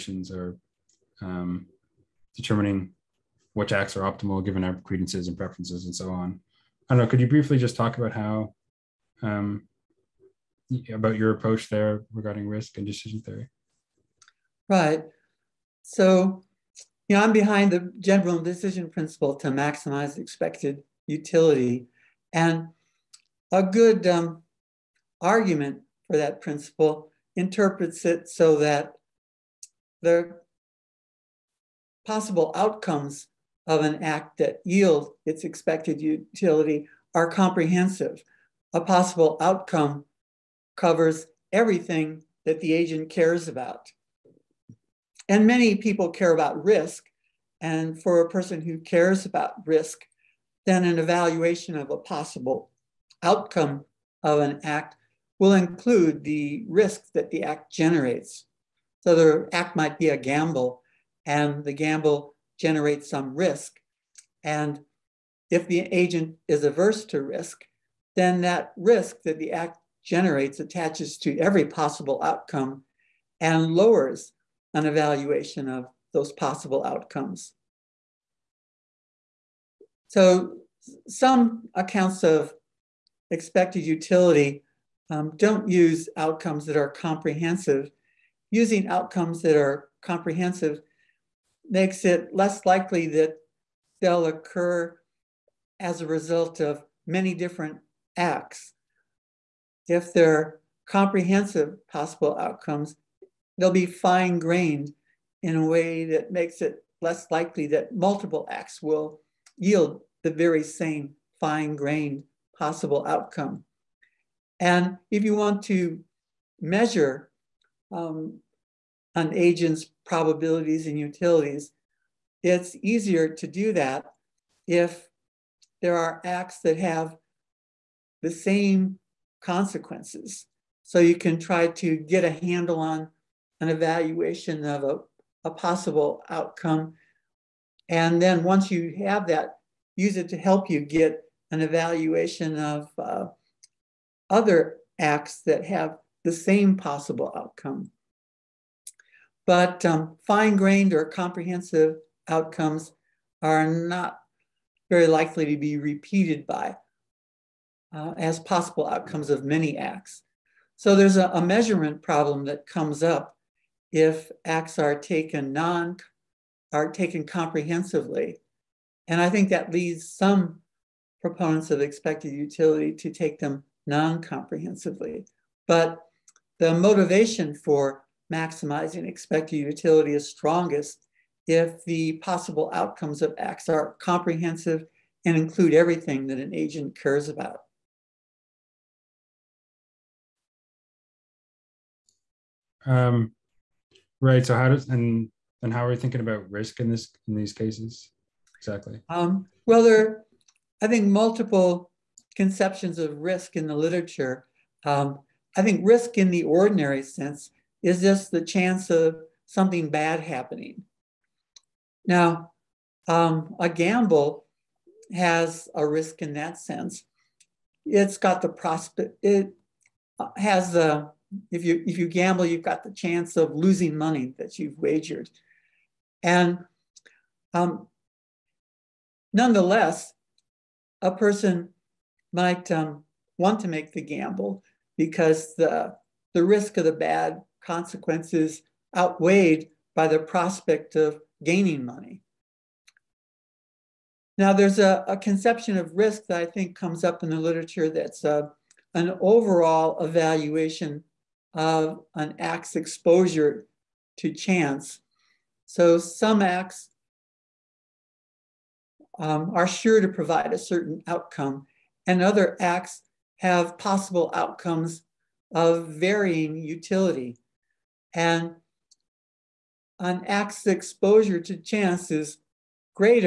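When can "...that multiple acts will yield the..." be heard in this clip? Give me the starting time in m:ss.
1:47.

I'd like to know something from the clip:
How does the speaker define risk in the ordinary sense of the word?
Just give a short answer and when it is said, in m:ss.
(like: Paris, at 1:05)
chance of something bad happening, at 3:28.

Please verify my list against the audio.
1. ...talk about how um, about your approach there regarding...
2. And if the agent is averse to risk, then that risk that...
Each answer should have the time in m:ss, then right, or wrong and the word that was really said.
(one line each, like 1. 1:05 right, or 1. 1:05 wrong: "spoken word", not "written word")
1. 0:07 right
2. 1:04 right.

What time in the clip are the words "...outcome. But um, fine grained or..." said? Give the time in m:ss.
2:27.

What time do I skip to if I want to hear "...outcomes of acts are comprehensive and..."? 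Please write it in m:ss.
3:02.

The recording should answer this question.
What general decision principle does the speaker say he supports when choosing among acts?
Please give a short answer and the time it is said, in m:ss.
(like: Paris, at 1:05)
maximize expected utility, at 0:19.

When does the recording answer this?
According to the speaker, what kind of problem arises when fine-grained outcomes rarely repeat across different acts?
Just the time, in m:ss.
2:41.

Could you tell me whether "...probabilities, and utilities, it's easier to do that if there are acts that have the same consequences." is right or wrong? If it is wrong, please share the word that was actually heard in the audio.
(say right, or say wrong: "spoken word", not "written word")
right.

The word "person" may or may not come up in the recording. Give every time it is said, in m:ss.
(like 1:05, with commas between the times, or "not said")
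0:48, 3:51.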